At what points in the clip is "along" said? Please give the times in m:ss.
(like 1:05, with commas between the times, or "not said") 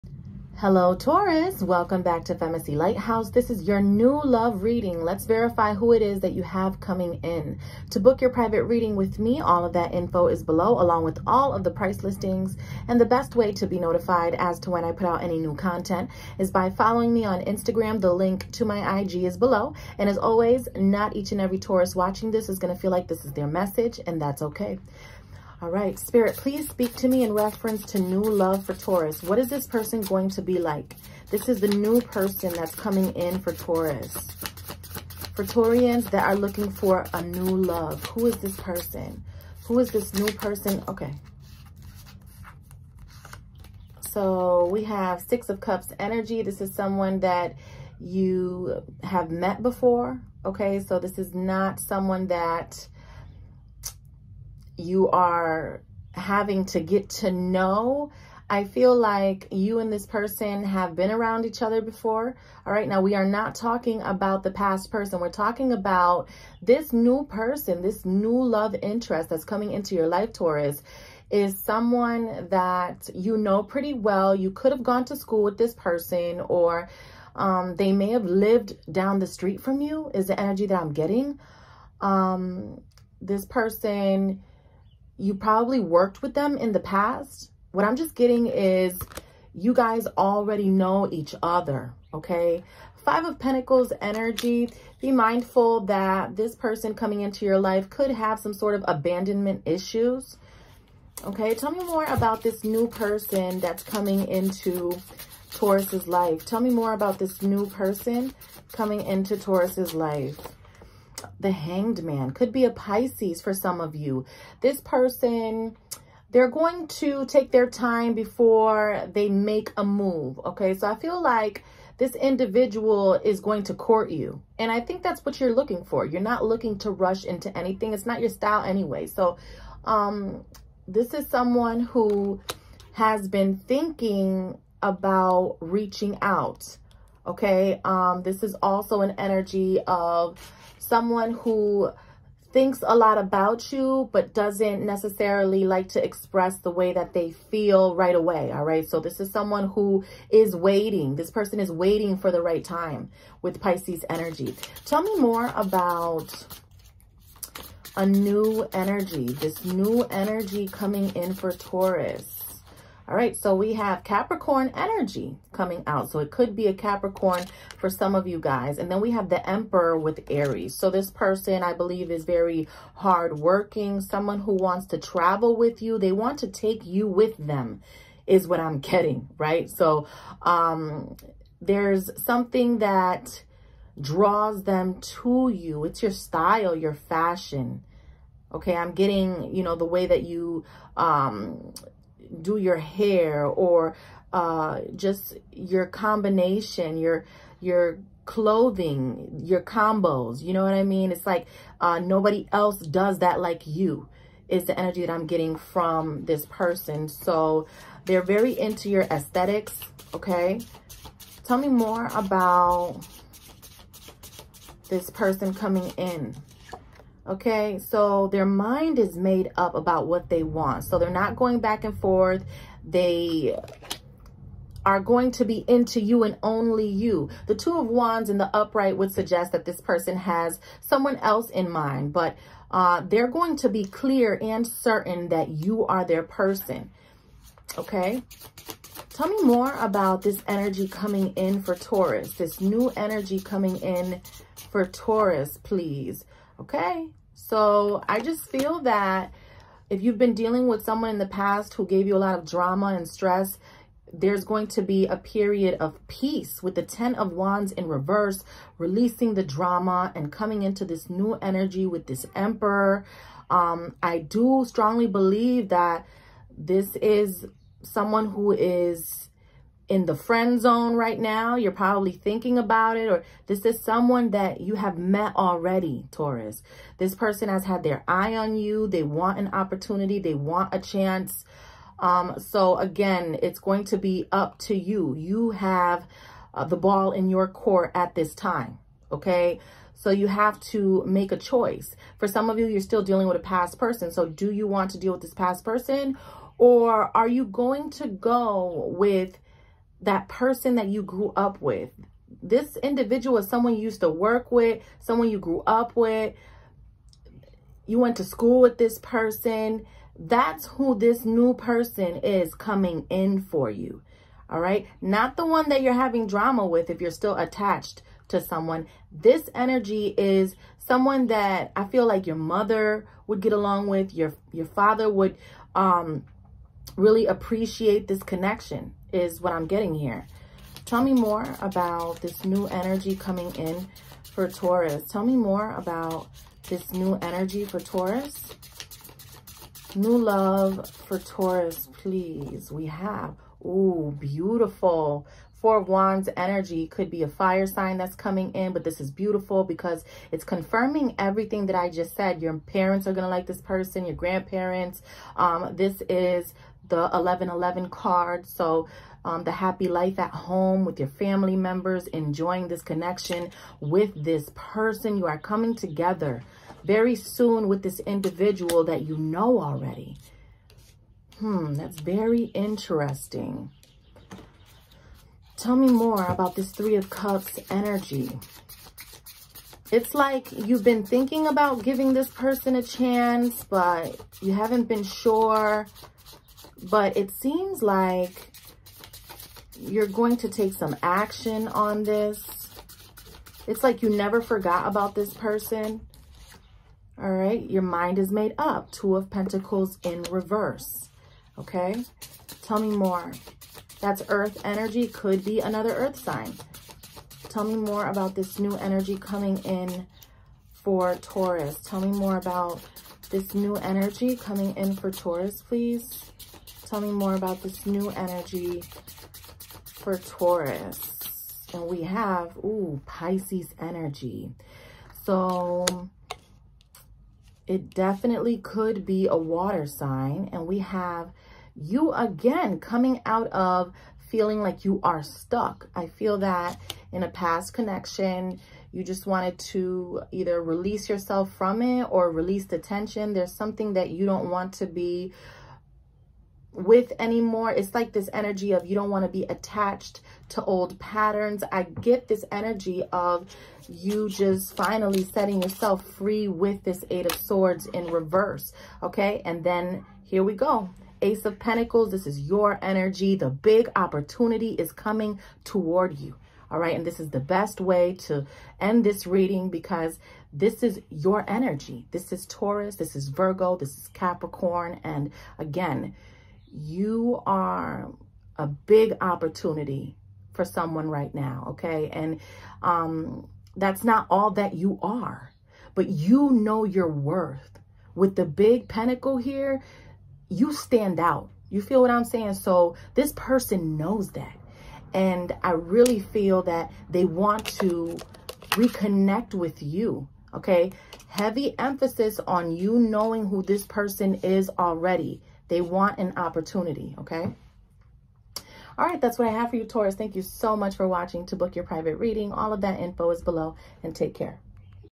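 0:10, 5:23.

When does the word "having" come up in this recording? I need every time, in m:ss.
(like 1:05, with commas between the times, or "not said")
0:56, 5:15.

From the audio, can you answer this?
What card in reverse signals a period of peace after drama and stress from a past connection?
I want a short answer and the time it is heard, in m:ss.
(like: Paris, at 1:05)
10 of Wands, at 4:16.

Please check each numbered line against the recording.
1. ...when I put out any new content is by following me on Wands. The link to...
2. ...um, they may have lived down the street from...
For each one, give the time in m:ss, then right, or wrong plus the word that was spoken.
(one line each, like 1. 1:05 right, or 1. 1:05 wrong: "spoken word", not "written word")
1. 0:14 wrong: "Instagram", not "Wands"
2. 1:17 right.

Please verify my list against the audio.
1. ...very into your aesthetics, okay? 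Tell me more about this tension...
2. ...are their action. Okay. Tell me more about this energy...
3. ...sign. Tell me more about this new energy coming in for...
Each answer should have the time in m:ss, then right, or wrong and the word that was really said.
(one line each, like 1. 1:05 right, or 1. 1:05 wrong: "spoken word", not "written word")
1. 3:28 wrong: "person", not "tension"
2. 3:55 wrong: "person", not "action"
3. 6:46 right.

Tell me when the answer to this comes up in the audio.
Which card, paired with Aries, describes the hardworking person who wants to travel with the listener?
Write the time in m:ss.
2:49.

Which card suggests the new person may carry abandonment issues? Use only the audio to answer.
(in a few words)
Five of Pentacles.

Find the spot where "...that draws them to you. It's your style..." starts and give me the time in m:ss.
3:02.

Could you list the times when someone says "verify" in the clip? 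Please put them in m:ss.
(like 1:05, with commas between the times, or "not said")
0:05.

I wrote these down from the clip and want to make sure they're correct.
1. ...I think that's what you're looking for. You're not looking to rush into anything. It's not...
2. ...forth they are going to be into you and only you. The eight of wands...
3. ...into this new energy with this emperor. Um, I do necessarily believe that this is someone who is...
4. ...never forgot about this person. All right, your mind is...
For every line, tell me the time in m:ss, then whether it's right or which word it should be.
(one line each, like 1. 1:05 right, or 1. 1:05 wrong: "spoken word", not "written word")
1. 2:04 right
2. 3:41 wrong: "two", not "eight"
3. 4:20 wrong: "strongly", not "necessarily"
4. 6:34 right.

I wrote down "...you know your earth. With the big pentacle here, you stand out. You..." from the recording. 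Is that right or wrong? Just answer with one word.
wrong.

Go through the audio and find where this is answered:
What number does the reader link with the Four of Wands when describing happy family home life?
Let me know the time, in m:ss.
5:57.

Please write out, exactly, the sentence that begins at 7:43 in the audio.
The big opportunity is coming toward you.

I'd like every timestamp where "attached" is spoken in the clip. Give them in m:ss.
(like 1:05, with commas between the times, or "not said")
5:17, 7:29.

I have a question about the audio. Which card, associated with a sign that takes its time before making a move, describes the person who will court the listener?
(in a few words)
The Hanged Man.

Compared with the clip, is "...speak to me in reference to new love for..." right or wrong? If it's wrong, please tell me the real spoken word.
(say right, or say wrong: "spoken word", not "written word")
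right.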